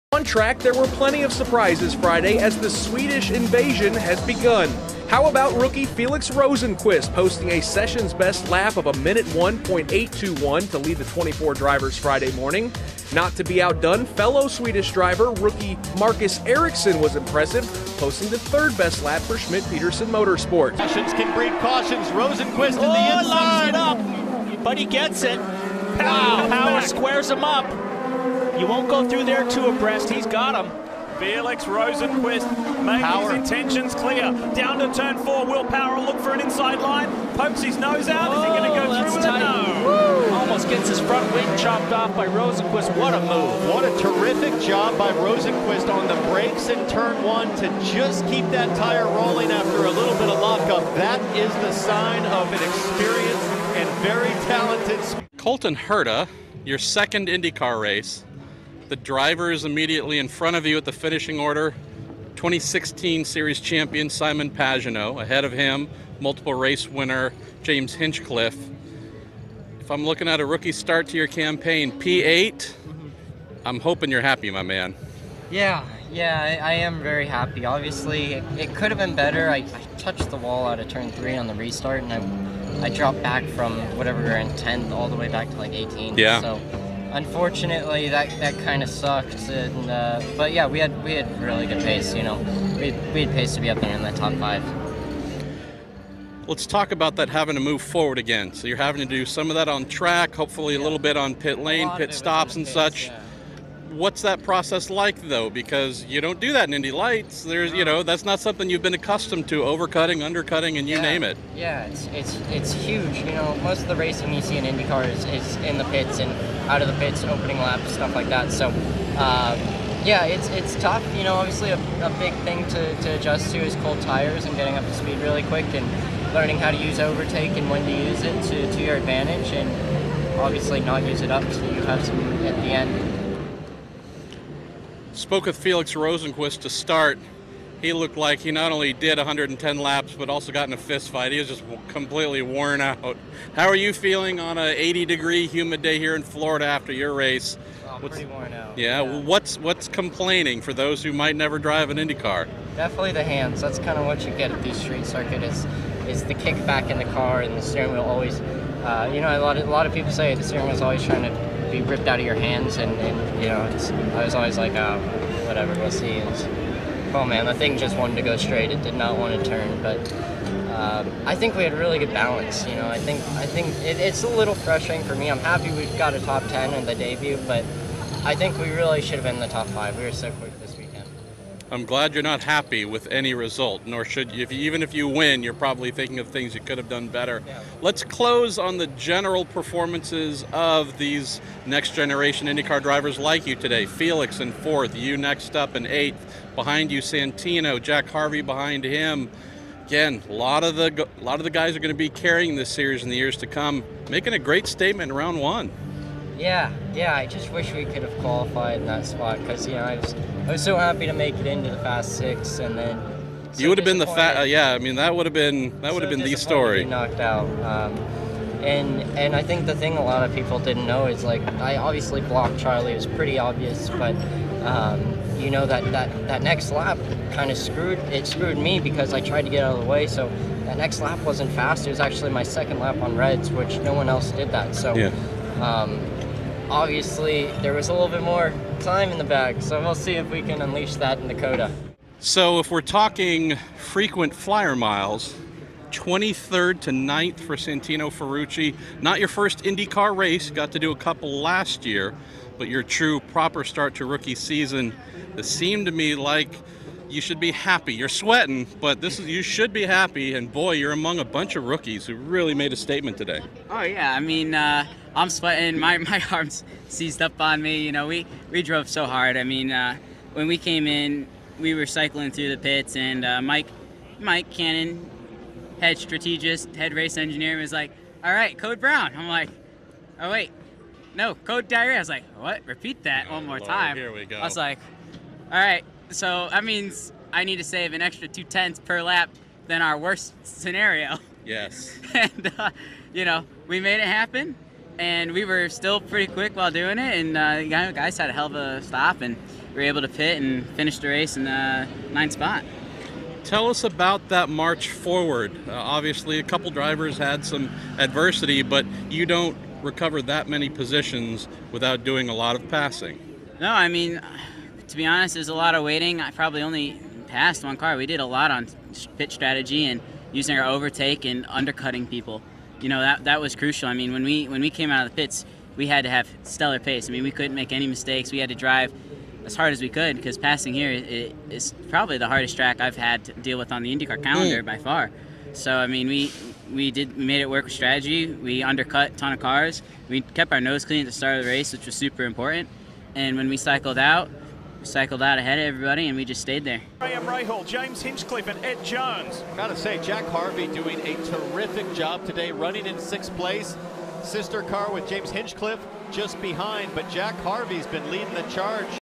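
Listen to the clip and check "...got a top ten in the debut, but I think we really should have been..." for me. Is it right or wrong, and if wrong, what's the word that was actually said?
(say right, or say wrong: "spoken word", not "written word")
right.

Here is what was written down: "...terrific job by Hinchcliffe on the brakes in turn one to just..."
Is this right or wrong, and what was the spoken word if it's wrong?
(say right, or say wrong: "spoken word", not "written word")
wrong: "Rosenqvist", not "Hinchcliffe".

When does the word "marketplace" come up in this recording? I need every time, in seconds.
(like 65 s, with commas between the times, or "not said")
not said.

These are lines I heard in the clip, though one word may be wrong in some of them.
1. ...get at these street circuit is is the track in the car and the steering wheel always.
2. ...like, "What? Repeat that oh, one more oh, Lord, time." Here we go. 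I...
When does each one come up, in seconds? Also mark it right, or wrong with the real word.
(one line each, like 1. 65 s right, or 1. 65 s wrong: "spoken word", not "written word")
1. 154 s wrong: "kickback", not "track"
2. 282 s right.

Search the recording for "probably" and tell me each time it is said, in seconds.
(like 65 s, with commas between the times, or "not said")
185 s, 316 s, 331 s.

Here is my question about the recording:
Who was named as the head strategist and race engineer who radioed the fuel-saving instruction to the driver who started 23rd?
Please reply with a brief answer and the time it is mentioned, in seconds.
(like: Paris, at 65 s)
Mike Cannon, at 274 s.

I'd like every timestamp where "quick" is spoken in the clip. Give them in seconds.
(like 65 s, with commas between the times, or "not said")
125 s, 180 s, 296 s.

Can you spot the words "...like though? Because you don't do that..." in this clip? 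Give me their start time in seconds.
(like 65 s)
104 s.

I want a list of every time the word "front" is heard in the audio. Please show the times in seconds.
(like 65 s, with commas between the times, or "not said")
40 s, 60 s.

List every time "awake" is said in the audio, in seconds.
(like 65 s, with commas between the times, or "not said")
not said.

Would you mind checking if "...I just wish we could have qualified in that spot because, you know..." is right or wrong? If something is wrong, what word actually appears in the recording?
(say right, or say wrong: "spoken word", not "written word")
right.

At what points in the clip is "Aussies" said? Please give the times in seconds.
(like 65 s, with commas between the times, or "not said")
not said.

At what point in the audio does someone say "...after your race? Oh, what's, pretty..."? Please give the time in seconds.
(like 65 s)
146 s.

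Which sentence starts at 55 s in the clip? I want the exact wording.
Colton Herta, your second IndyCar race.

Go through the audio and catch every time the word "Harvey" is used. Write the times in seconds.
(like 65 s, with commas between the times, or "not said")
198 s, 350 s, 357 s.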